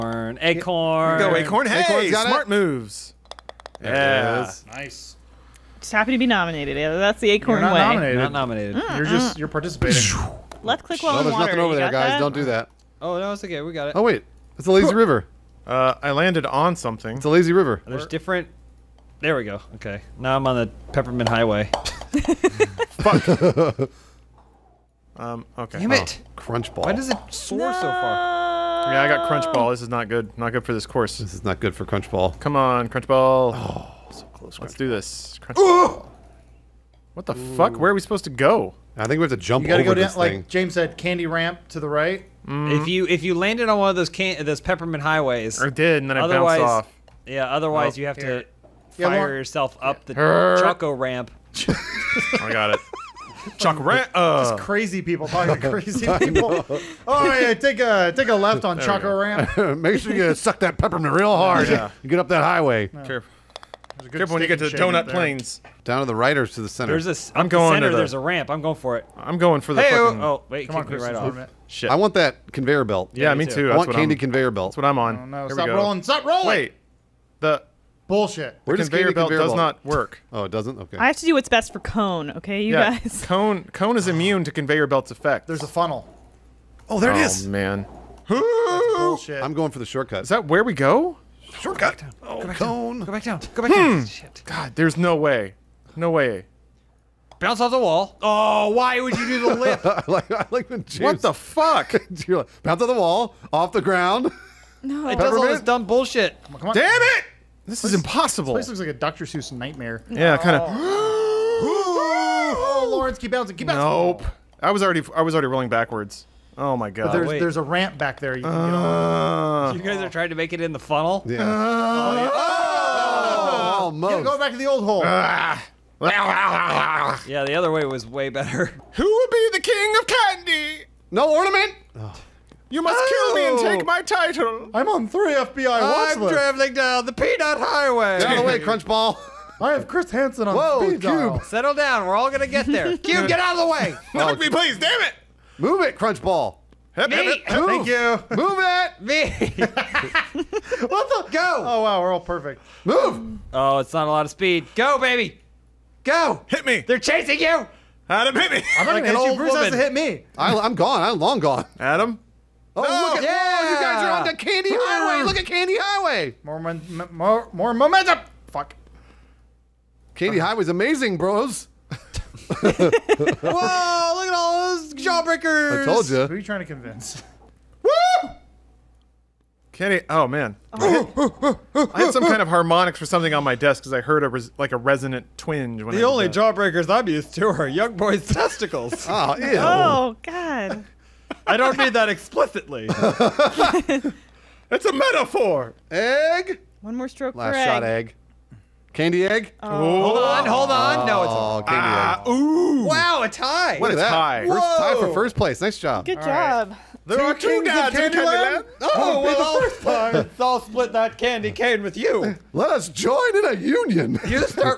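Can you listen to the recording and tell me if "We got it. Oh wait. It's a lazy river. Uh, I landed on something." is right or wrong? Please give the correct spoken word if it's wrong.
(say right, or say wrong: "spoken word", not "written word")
right.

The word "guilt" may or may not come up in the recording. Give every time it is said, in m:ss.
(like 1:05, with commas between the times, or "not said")
not said.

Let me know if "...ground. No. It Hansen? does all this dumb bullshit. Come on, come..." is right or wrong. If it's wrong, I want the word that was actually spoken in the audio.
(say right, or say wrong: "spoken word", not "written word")
wrong: "Peppermint", not "Hansen".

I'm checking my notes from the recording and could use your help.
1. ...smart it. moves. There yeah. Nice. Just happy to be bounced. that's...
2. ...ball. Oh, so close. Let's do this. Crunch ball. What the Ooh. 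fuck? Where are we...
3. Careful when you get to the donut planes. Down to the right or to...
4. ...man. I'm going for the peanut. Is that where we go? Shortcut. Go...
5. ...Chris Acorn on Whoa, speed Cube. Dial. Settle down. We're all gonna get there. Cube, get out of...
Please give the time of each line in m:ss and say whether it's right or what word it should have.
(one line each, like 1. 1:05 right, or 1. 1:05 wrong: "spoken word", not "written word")
1. 0:02 wrong: "nominated", not "bounced"
2. 0:33 right
3. 1:04 right
4. 1:27 wrong: "shortcut", not "peanut"
5. 2:19 wrong: "Hansen", not "Acorn".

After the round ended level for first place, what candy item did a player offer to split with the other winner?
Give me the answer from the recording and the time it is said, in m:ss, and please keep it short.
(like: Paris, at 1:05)
candy cane, at 3:31.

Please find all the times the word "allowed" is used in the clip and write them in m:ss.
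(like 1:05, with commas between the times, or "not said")
not said.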